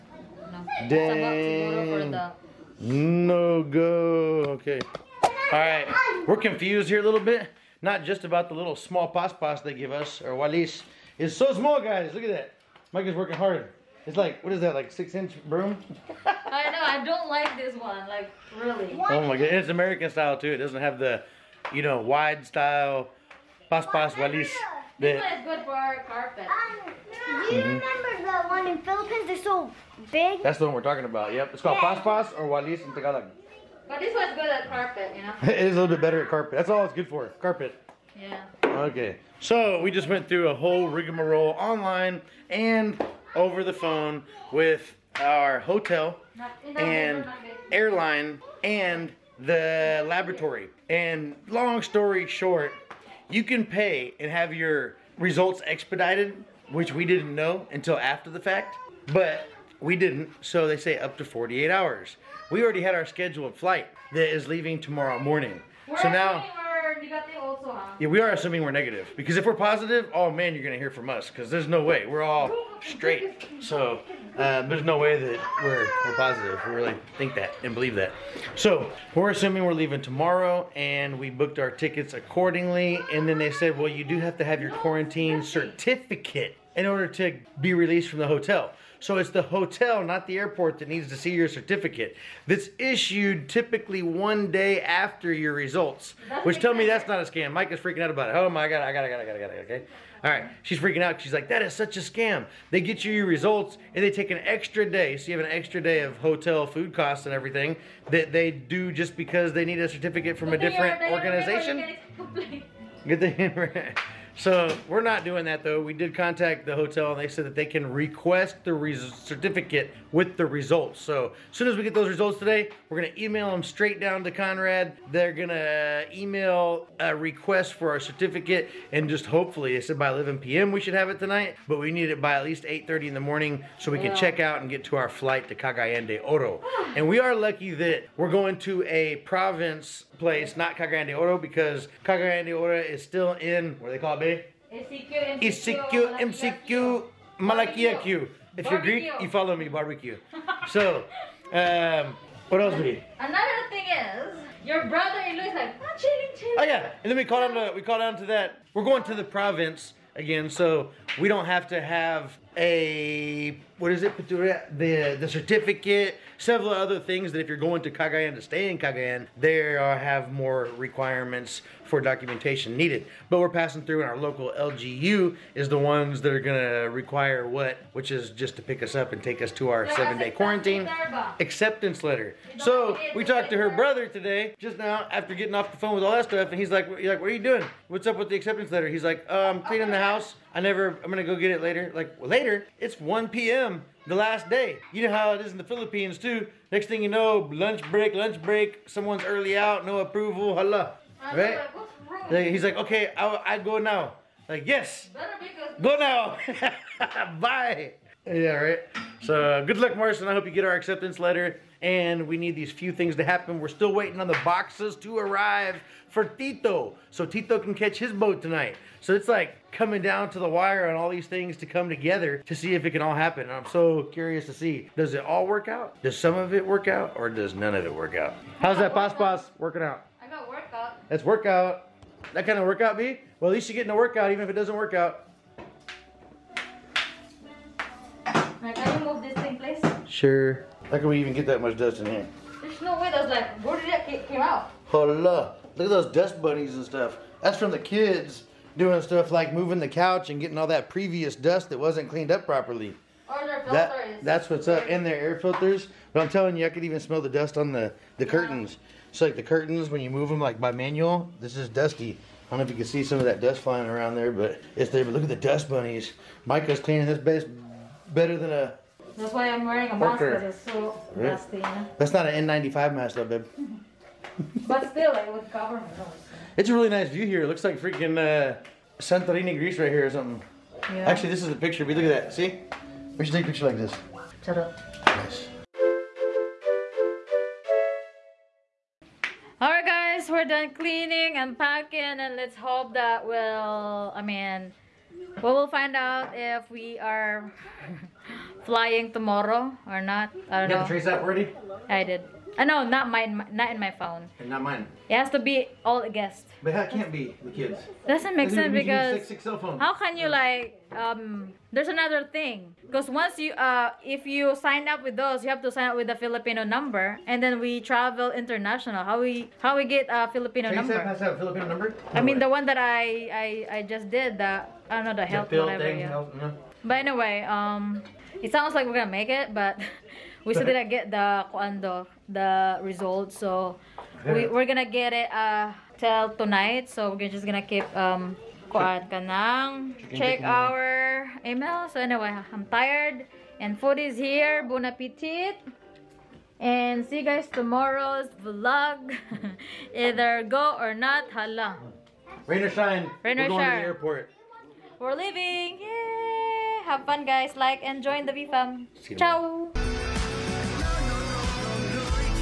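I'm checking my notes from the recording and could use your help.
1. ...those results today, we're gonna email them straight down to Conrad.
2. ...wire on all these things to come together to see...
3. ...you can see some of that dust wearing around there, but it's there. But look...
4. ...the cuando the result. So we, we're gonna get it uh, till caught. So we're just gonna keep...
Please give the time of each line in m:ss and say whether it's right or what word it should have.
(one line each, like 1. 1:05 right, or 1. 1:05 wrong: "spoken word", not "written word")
1. 2:01 right
2. 3:40 right
3. 4:22 wrong: "flying", not "wearing"
4. 5:31 wrong: "tonight", not "caught".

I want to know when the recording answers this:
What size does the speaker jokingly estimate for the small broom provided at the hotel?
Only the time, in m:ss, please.
0:14.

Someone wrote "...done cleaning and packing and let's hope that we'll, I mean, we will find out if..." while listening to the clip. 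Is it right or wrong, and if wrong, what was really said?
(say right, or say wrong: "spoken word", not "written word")
right.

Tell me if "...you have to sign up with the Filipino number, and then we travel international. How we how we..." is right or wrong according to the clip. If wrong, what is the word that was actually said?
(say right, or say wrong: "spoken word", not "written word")
right.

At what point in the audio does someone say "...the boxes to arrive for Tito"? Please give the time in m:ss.
3:34.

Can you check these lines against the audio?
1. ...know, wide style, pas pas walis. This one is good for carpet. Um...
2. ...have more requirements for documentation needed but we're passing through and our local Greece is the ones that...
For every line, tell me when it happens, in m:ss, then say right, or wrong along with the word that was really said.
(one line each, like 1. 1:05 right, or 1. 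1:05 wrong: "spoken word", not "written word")
1. 0:21 right
2. 2:49 wrong: "LGU", not "Greece".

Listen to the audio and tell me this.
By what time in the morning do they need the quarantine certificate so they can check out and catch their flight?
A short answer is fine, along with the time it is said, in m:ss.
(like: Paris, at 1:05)
8:30, at 2:12.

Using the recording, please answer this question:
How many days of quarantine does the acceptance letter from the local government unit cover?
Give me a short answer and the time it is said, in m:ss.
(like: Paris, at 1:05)
7 days, at 2:59.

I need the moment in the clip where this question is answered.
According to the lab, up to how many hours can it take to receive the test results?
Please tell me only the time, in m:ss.
1:01.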